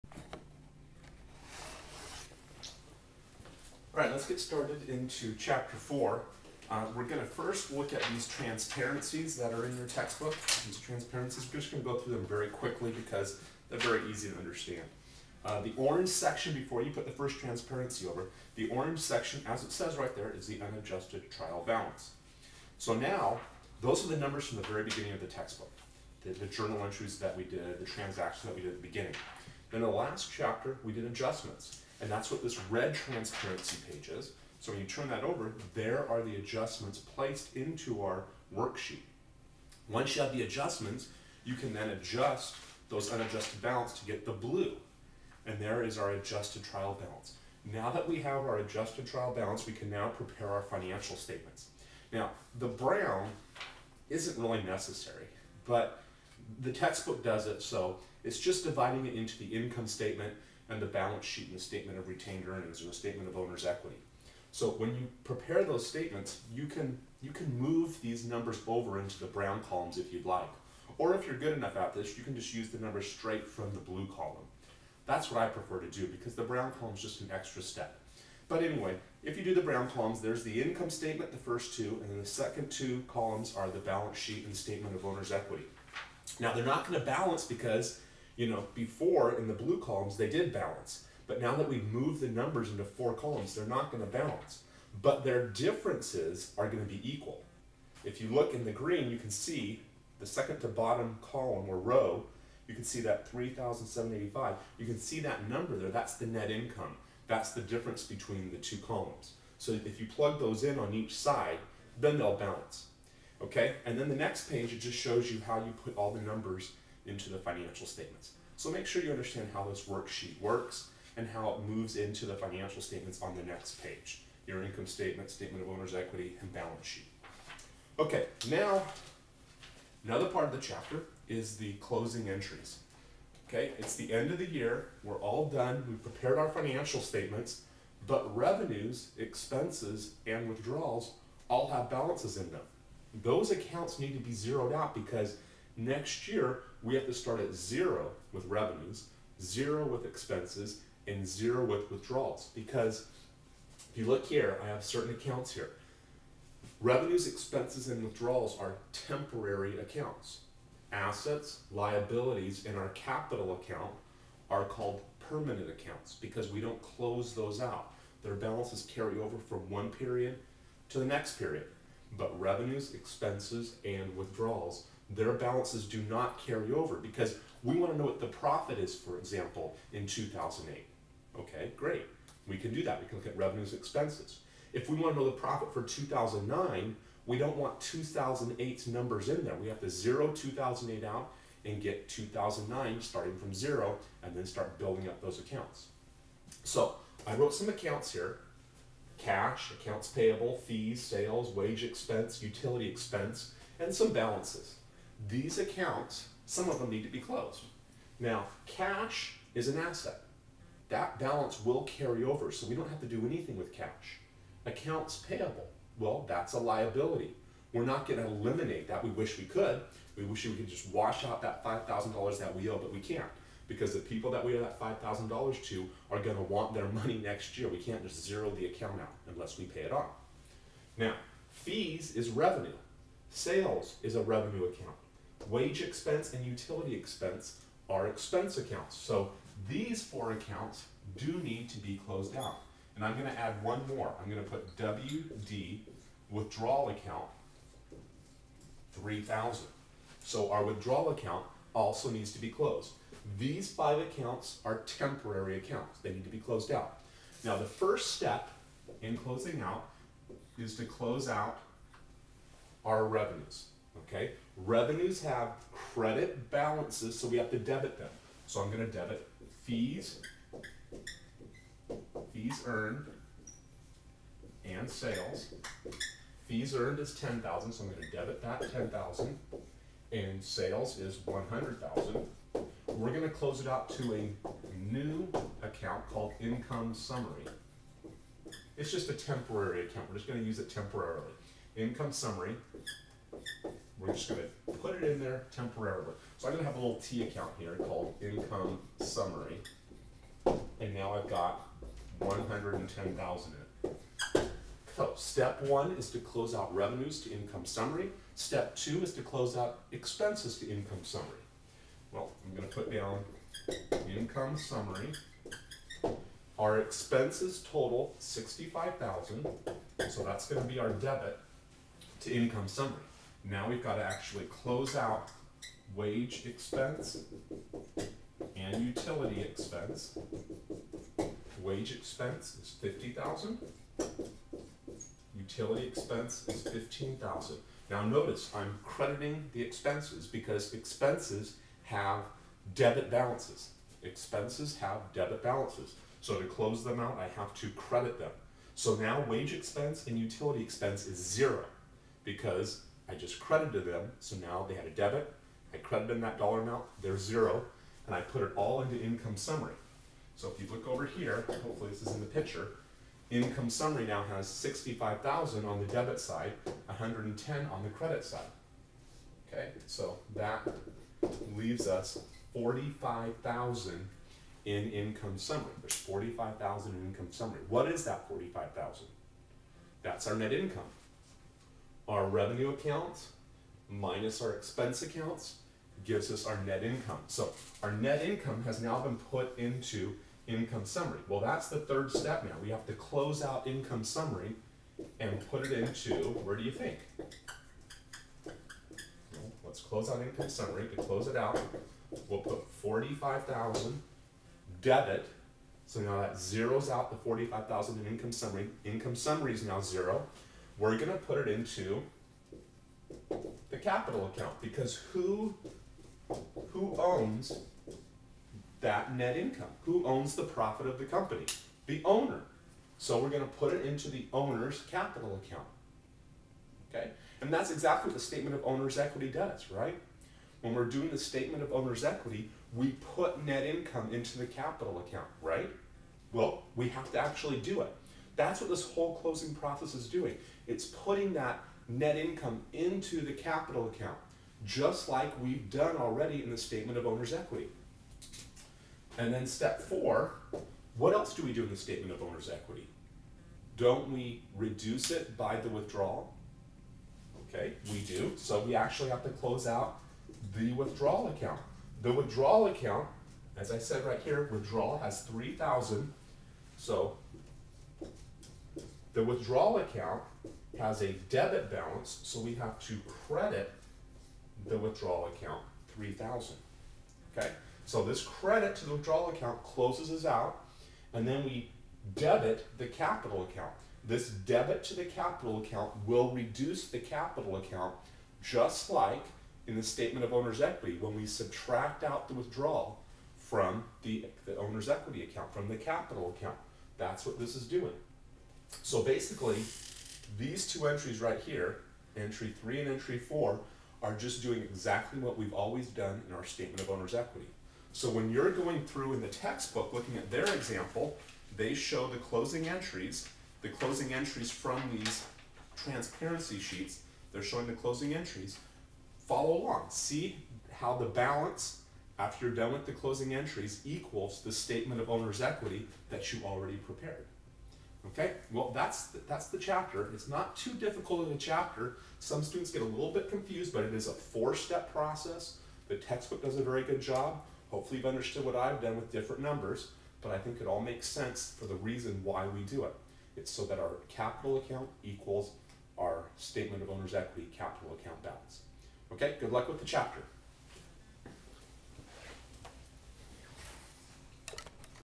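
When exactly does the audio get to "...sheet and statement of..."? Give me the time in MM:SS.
01:24.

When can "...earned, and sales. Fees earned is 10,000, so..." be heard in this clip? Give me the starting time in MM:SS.
04:32.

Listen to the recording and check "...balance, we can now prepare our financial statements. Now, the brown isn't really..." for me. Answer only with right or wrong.
right.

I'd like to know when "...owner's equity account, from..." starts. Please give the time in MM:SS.
08:14.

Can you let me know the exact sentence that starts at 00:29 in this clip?
Then the last chapter, we did adjustments.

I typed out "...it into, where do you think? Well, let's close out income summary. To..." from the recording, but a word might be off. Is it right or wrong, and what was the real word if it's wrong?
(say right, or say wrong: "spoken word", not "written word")
right.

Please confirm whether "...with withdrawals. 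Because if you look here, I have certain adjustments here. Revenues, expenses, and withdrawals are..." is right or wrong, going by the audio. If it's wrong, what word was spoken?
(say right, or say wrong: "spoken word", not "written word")
wrong: "accounts", not "adjustments".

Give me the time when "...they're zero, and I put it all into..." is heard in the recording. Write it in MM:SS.
05:57.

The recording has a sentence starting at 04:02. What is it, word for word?
And I'm going to add one more.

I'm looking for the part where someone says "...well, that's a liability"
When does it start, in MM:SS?
03:35.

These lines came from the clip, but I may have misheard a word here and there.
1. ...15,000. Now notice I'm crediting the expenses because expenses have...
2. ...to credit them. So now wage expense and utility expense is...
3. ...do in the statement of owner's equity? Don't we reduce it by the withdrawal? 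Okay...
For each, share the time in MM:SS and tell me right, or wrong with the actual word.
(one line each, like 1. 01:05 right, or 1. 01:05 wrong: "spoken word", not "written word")
1. 05:36 right
2. 05:47 right
3. 07:31 right.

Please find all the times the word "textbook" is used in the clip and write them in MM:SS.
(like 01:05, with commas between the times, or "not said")
00:09, 00:25, 00:56, 08:29, 08:55.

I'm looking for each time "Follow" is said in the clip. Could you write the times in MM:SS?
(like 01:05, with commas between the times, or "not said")
08:39.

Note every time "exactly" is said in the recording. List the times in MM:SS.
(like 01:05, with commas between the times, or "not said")
07:07, 08:24.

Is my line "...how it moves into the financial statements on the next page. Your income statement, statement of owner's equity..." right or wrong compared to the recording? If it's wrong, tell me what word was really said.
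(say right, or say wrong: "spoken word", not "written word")
right.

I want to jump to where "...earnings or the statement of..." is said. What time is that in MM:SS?
01:02.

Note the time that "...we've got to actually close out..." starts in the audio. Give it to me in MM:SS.
05:23.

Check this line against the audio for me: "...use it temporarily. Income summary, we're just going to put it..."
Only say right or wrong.
right.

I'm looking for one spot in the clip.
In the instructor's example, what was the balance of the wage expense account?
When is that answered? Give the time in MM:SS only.
05:32.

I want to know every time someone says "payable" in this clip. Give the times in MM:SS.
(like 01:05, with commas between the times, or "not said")
03:20, 03:35.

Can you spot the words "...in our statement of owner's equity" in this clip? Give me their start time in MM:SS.
08:26.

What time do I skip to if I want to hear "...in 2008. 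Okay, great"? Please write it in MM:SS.
02:59.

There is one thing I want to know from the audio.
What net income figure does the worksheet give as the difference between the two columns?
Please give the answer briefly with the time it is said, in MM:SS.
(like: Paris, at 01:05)
3,785, at 01:43.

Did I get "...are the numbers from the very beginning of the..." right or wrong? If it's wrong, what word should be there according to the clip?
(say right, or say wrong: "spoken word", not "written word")
right.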